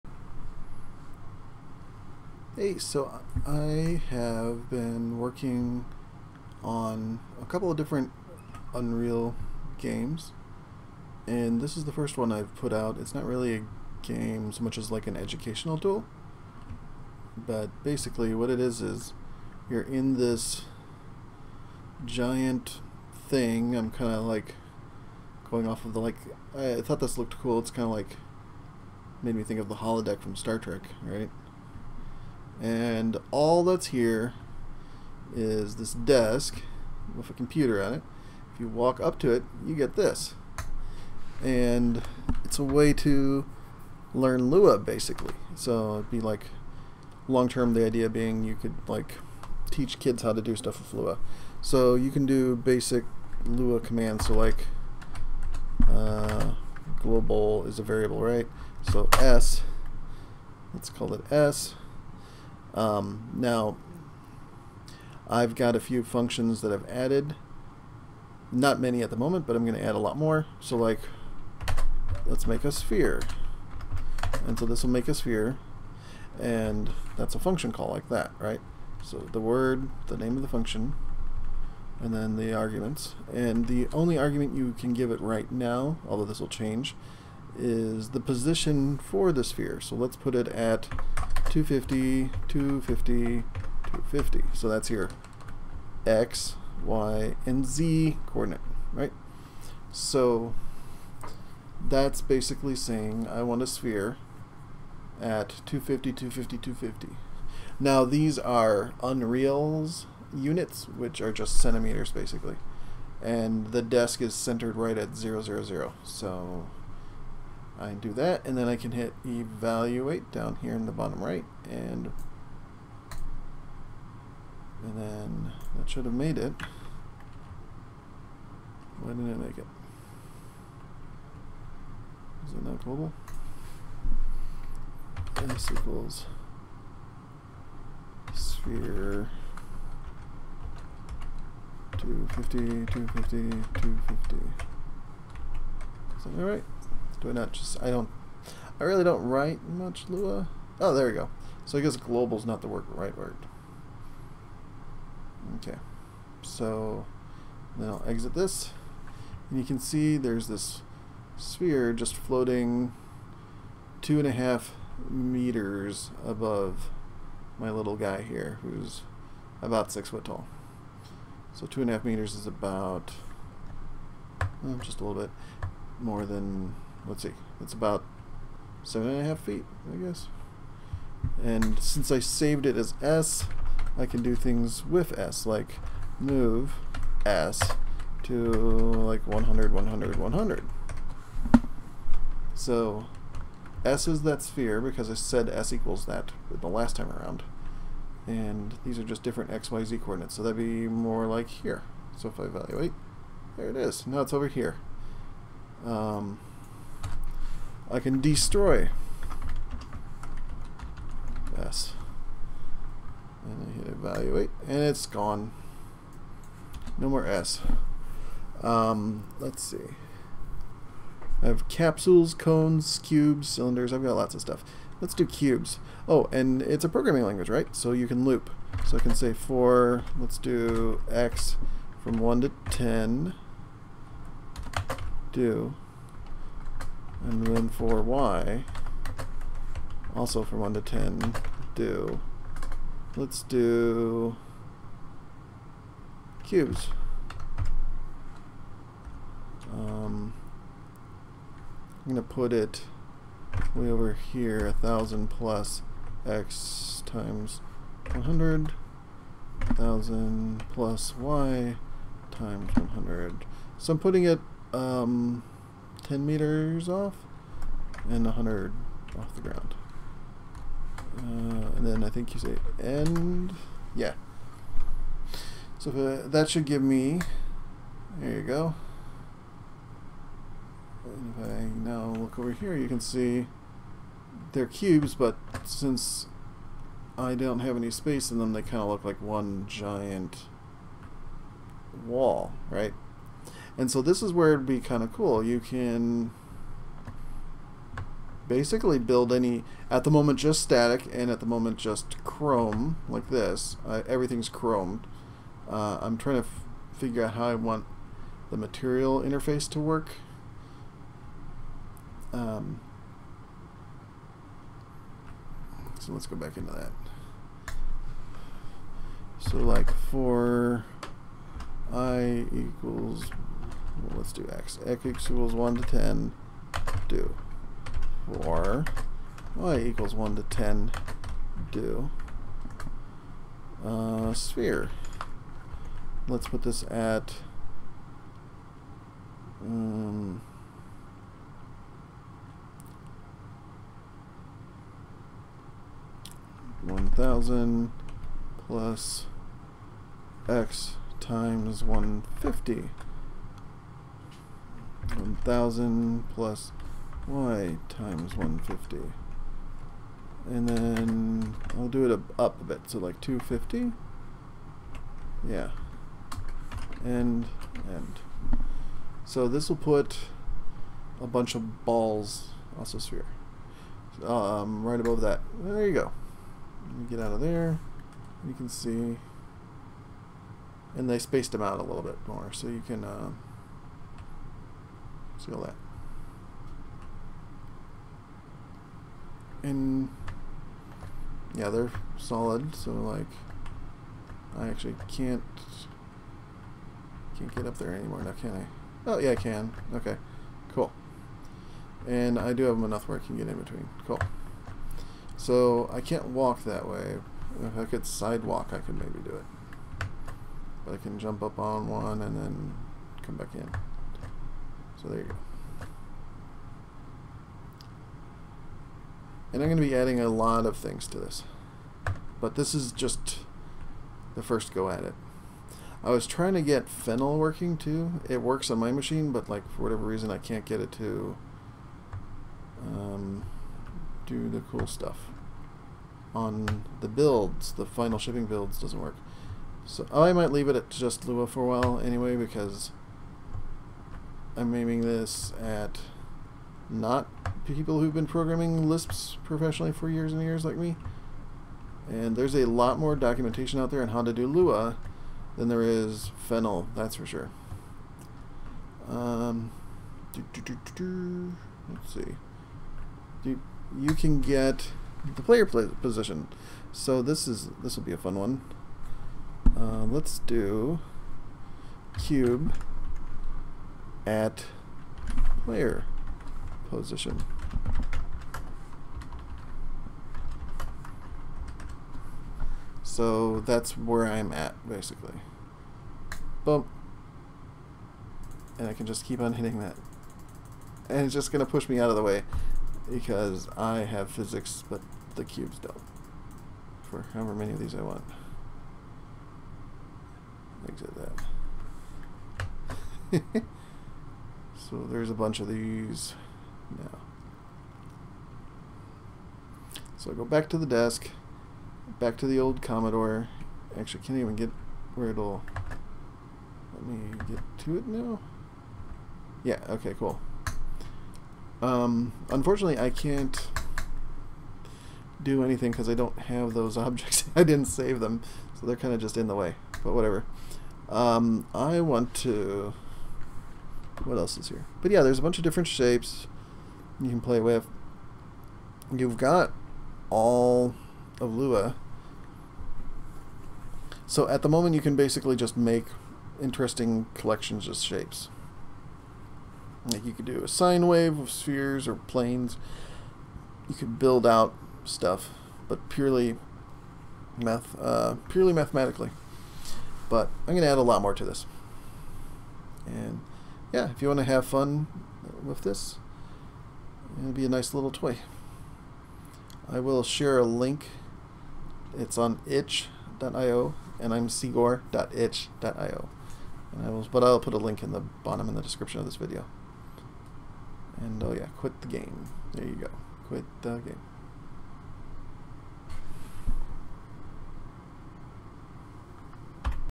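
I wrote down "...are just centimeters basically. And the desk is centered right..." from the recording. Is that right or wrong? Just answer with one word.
right.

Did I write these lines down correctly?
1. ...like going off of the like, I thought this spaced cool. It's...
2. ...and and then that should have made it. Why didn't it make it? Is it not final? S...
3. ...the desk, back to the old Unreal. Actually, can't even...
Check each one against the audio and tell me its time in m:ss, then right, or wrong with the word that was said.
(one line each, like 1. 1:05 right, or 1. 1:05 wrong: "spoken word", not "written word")
1. 0:24 wrong: "looked", not "spaced"
2. 2:01 wrong: "global", not "final"
3. 8:30 wrong: "Commodore", not "Unreal".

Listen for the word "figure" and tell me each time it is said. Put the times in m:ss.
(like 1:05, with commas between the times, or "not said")
5:06.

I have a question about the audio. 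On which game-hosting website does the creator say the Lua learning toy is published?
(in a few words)
itch.io.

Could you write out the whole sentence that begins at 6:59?
And I'm going to be adding a lot of things to this.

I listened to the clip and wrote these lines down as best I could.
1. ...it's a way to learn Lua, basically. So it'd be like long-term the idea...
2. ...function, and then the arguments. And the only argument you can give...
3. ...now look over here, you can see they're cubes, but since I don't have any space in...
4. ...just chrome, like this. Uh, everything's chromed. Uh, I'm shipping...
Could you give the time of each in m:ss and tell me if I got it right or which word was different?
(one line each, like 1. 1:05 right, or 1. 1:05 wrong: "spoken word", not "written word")
1. 0:42 right
2. 1:20 right
3. 4:41 right
4. 5:01 wrong: "trying", not "shipping".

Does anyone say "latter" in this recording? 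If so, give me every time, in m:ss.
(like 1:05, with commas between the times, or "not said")
not said.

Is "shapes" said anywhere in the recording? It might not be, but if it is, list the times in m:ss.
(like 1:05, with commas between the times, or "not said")
8:55, 9:07.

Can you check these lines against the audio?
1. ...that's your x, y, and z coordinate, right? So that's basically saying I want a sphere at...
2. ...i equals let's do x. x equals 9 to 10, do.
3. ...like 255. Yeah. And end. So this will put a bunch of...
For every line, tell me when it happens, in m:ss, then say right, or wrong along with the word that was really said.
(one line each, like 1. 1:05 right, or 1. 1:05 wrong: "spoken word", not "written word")
1. 1:34 right
2. 5:21 wrong: "1", not "9"
3. 6:02 wrong: "250", not "255".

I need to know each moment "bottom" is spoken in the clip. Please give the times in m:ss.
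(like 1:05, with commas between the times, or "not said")
2:00, 9:38.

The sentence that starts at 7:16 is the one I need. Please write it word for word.
On the builds, the final shipping builds doesn't work.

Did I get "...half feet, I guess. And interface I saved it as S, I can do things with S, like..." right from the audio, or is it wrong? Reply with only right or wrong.
wrong.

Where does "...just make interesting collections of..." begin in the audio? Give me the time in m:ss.
9:05.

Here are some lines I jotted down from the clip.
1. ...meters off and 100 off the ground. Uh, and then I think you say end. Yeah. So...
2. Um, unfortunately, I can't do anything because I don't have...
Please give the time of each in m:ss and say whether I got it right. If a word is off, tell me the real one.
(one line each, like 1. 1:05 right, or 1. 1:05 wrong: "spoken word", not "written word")
1. 4:26 right
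2. 8:41 right.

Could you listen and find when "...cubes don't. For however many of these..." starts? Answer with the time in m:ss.
8:15.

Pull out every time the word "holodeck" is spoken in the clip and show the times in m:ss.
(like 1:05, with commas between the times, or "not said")
0:29.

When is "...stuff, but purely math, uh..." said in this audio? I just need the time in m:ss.
9:15.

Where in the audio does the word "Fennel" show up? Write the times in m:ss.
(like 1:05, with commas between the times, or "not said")
7:06, 7:36.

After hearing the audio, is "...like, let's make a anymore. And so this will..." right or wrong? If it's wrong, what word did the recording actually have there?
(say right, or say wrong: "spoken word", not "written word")
wrong: "sphere", not "anymore".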